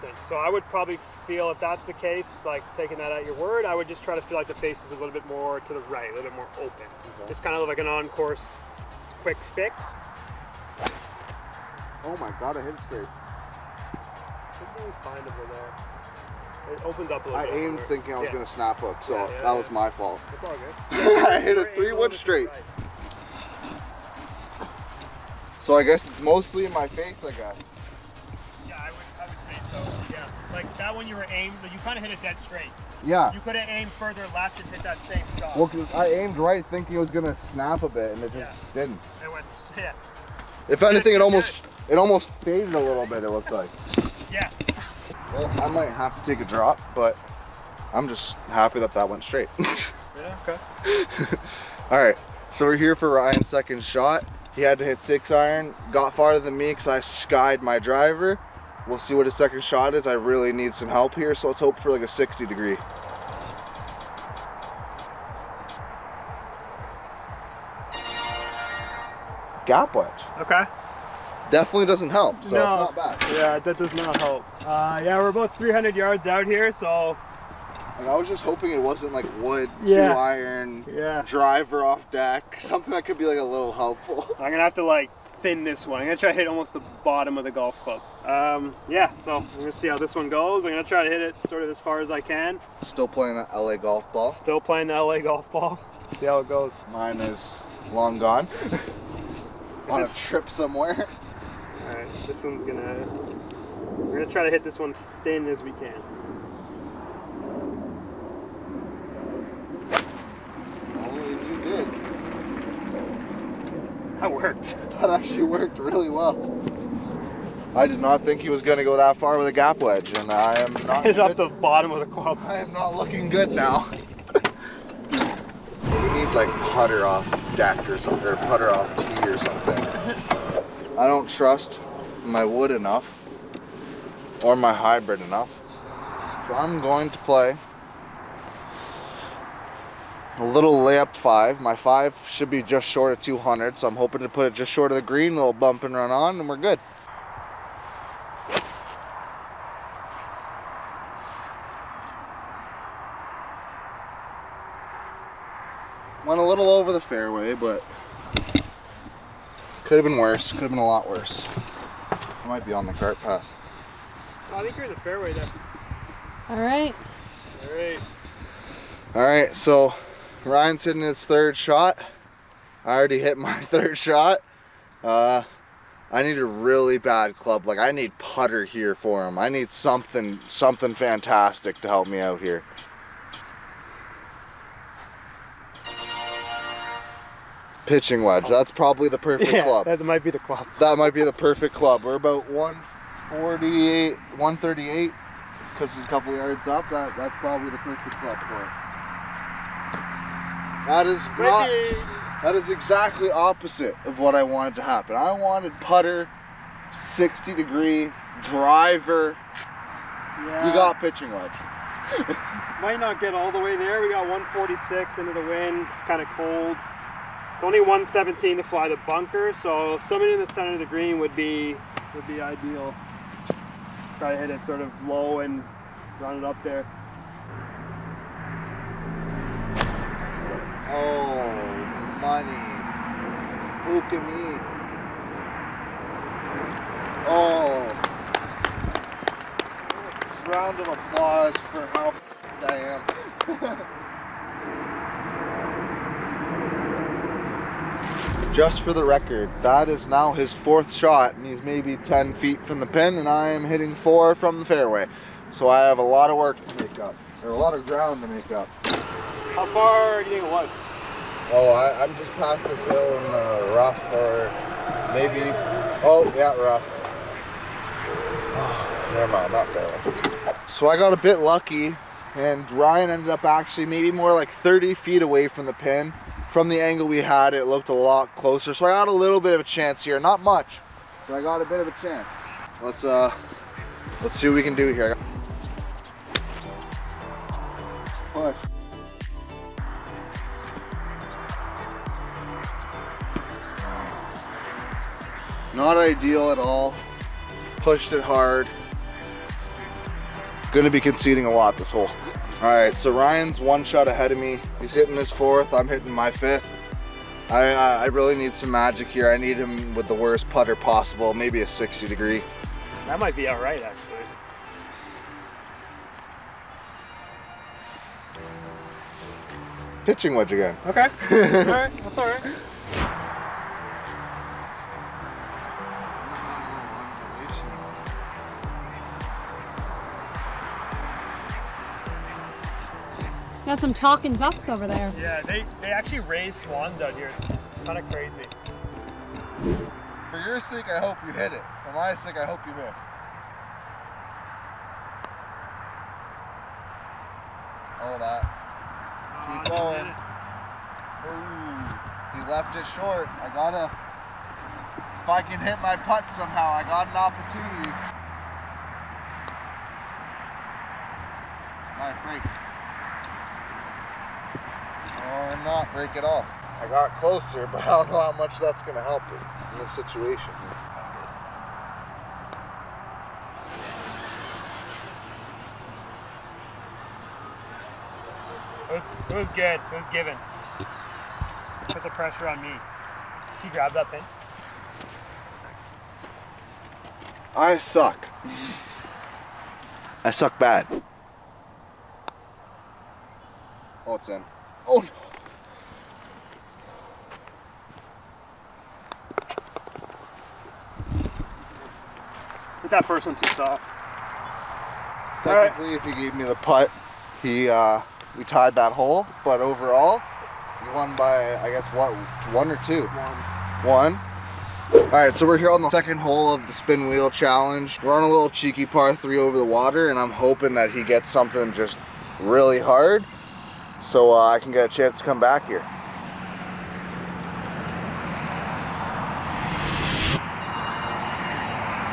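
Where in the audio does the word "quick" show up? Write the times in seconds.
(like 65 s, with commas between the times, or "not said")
9 s.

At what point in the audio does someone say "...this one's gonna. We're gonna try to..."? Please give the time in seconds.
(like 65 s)
102 s.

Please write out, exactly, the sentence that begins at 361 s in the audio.
All right, break not break it off.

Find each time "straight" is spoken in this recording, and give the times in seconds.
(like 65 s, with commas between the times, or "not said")
12 s, 22 s, 32 s, 49 s.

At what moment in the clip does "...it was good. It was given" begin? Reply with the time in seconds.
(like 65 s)
379 s.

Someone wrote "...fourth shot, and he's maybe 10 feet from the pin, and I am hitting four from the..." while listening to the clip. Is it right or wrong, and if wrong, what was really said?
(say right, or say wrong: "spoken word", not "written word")
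right.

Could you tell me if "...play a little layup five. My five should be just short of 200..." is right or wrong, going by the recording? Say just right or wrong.
right.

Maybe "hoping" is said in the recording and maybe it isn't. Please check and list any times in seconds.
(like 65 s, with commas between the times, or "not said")
78 s, 143 s, 420 s.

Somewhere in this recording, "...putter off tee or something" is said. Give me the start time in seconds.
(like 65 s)
128 s.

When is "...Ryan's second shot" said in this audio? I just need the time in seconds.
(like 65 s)
53 s.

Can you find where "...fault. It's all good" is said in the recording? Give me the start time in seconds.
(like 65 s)
19 s.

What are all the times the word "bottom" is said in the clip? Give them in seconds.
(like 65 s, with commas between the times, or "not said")
87 s, 121 s.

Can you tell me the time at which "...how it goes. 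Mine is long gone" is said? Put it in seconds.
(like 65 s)
96 s.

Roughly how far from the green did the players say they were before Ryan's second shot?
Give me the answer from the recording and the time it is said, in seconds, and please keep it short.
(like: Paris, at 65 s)
300 yards, at 75 s.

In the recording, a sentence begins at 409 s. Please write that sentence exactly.
But overall, he won by I guess what one or two.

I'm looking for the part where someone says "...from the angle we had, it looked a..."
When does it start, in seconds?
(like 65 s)
276 s.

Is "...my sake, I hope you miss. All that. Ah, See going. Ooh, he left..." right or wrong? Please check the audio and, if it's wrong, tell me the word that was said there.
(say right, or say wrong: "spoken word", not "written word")
wrong: "Keep", not "See".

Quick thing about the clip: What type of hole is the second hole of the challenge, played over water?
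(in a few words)
par three.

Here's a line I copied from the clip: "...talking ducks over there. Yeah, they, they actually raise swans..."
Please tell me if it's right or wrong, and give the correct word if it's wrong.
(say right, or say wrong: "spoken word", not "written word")
right.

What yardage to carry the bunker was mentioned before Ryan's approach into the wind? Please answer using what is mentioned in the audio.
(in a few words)
117.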